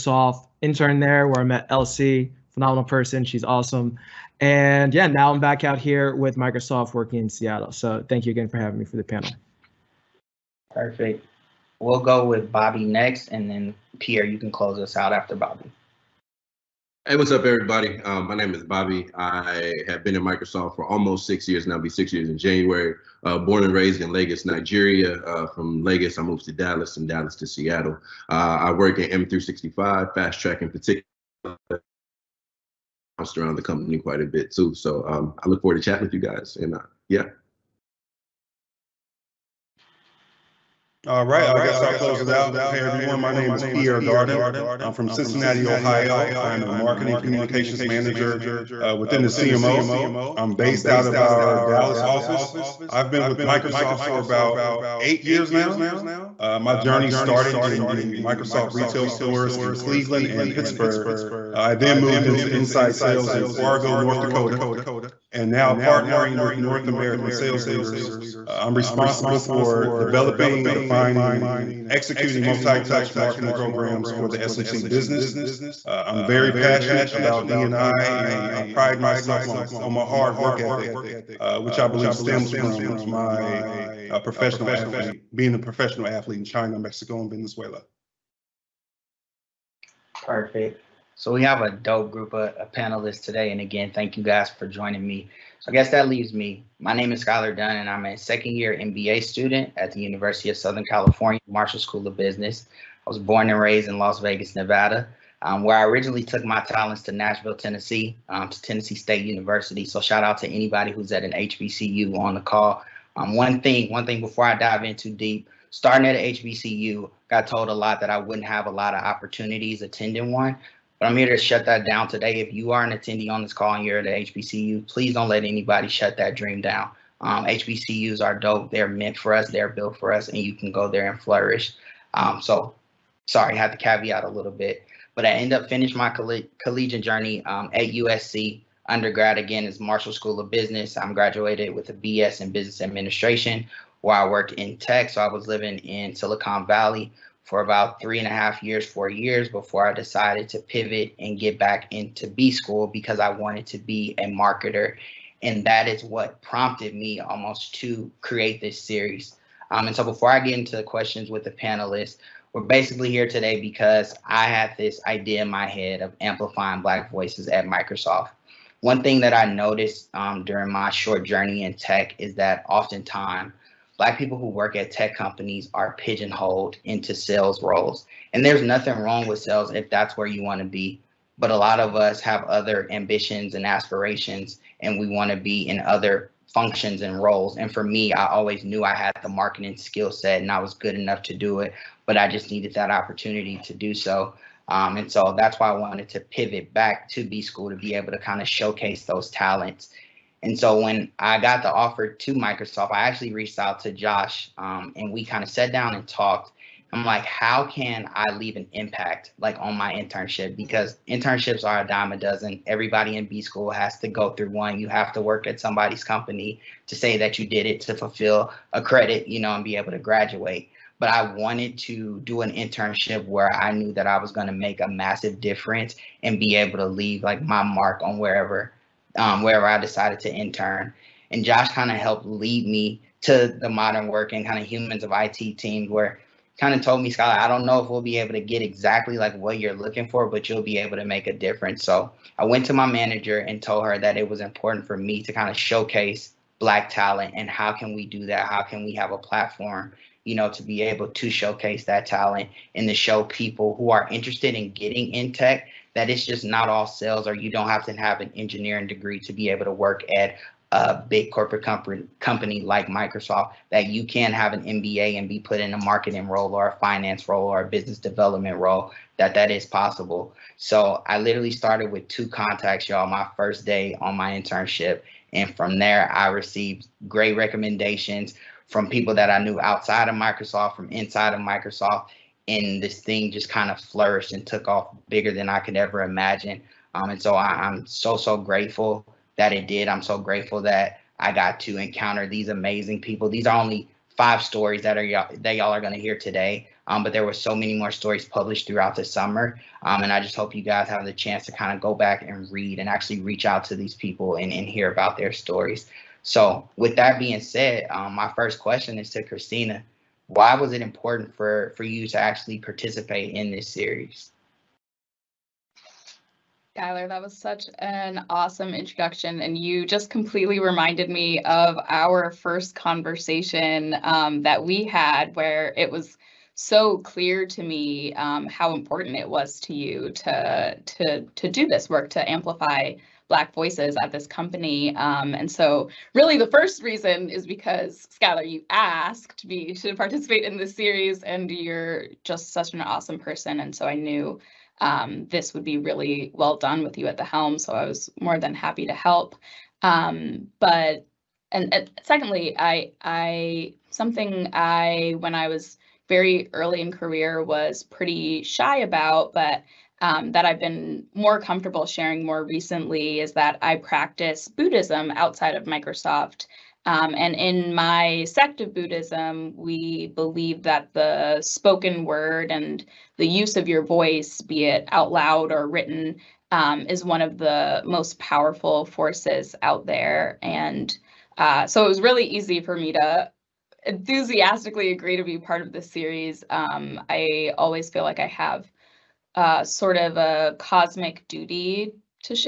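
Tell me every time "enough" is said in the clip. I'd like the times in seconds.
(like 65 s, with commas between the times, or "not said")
190 s.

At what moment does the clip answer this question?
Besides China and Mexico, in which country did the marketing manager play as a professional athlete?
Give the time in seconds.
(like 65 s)
87 s.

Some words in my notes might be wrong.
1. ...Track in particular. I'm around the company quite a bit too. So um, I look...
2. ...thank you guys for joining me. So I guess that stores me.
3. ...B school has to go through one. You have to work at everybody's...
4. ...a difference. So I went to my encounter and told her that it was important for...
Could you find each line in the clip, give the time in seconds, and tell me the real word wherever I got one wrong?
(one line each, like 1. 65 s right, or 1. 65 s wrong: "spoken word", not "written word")
1. 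30 s right
2. 93 s wrong: "leaves", not "stores"
3. 213 s wrong: "somebody", not "everybody"
4. 241 s wrong: "manager", not "encounter".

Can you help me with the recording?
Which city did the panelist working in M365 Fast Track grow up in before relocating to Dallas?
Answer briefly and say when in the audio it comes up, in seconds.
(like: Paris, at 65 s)
Lagos, Nigeria, at 24 s.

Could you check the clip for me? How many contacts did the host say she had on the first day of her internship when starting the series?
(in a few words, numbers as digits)
2.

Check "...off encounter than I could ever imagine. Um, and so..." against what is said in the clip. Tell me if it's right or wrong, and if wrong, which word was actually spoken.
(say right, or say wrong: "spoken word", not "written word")
wrong: "bigger", not "encounter".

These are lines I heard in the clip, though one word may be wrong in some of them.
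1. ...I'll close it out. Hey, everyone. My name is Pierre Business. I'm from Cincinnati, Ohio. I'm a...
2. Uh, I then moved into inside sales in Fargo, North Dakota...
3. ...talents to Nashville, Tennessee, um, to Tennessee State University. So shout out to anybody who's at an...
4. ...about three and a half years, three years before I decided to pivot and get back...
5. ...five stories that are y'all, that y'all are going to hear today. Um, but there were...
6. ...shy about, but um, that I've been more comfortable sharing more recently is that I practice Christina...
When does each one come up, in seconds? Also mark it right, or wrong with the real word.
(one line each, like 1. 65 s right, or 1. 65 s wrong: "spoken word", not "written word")
1. 41 s wrong: "Darden", not "Business"
2. 61 s right
3. 106 s right
4. 147 s wrong: "four", not "three"
5. 294 s right
6. 358 s wrong: "Buddhism", not "Christina".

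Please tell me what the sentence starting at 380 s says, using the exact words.
And uh, so it was really easy for me to enthusiastically agree to be part of this series.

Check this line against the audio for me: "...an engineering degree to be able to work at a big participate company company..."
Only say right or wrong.
wrong.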